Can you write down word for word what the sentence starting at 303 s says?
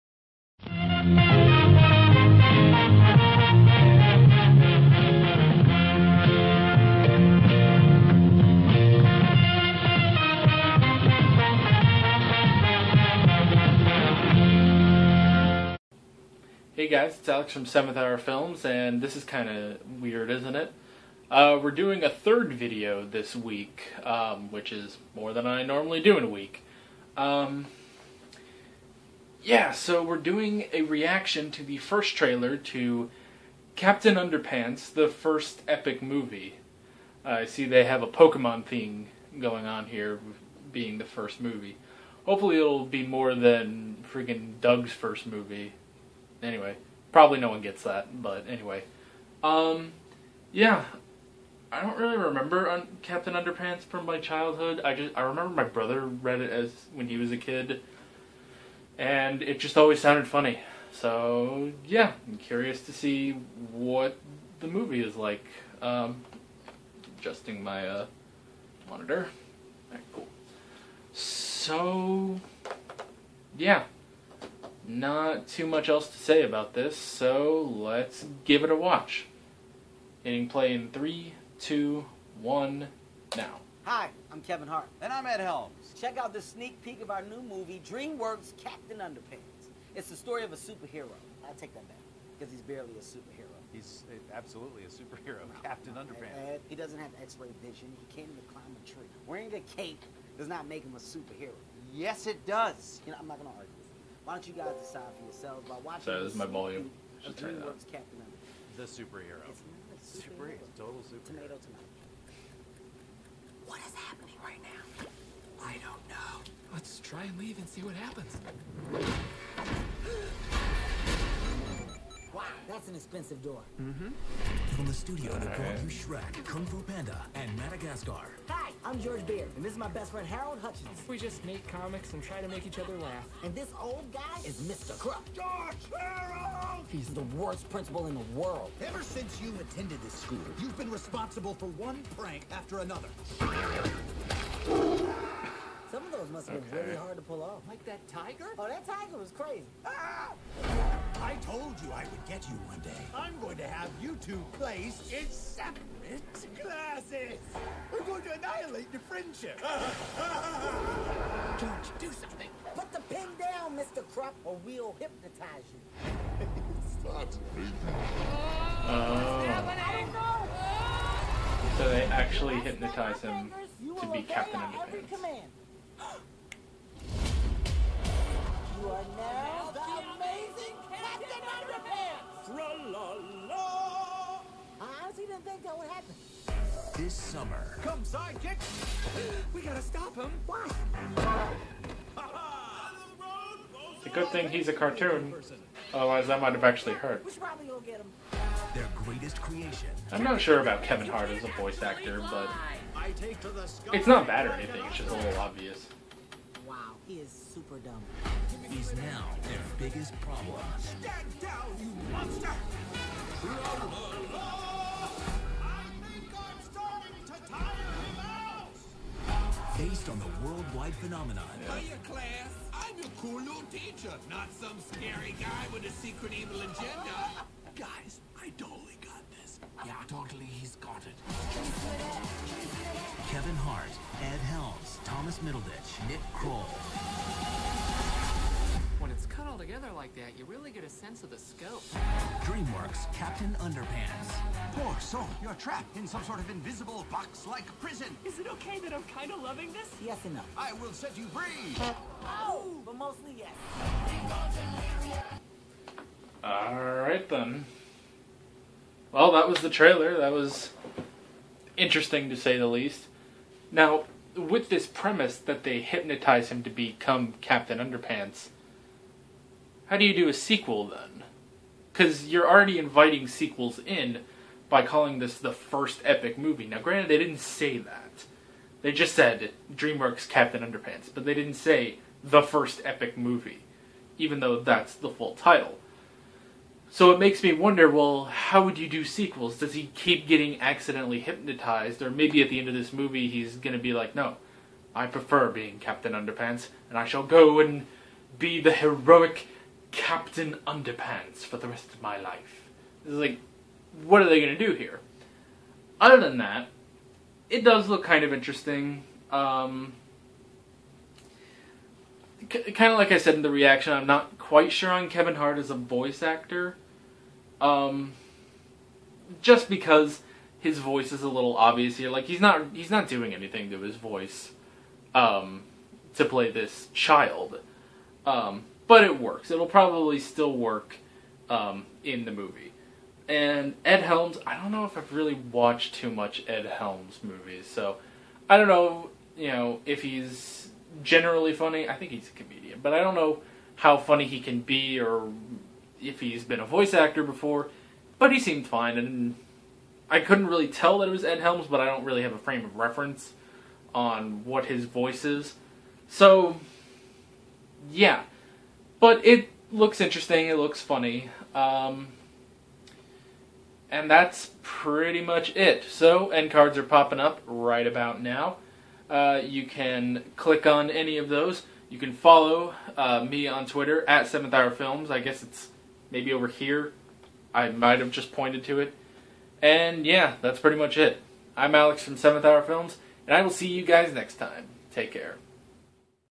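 It's like, what are they going to do here?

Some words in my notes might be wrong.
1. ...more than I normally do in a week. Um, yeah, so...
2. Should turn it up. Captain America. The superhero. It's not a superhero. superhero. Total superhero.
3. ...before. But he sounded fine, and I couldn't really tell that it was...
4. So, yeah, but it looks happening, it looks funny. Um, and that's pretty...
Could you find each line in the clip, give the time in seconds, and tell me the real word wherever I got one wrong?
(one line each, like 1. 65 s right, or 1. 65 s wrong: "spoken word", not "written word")
1. 25 s right
2. 107 s right
3. 347 s wrong: "seemed", not "sounded"
4. 356 s wrong: "interesting", not "happening".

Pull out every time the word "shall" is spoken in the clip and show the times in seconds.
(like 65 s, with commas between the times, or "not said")
297 s.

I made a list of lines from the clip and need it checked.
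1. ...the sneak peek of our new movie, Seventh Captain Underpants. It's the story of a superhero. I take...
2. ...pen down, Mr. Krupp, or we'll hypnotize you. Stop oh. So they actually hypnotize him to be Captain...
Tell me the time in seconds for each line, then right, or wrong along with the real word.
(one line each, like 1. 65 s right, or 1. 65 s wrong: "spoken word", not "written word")
1. 86 s wrong: "DreamWorks", not "Seventh"
2. 163 s right.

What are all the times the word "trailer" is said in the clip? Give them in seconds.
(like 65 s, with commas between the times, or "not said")
32 s, 259 s.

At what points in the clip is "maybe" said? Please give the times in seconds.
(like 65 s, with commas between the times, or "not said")
292 s, 376 s.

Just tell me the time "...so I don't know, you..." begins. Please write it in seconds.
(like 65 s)
337 s.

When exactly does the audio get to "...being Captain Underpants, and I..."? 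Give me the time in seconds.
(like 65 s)
295 s.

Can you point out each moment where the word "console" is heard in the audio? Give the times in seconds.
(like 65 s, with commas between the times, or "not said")
not said.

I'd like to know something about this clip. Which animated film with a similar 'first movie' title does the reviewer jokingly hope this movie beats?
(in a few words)
Doug's 1st Movie.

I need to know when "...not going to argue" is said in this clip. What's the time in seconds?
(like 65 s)
103 s.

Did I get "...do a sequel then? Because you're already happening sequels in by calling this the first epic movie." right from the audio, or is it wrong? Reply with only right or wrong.
wrong.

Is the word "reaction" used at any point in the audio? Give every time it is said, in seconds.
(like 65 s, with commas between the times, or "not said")
30 s, 313 s.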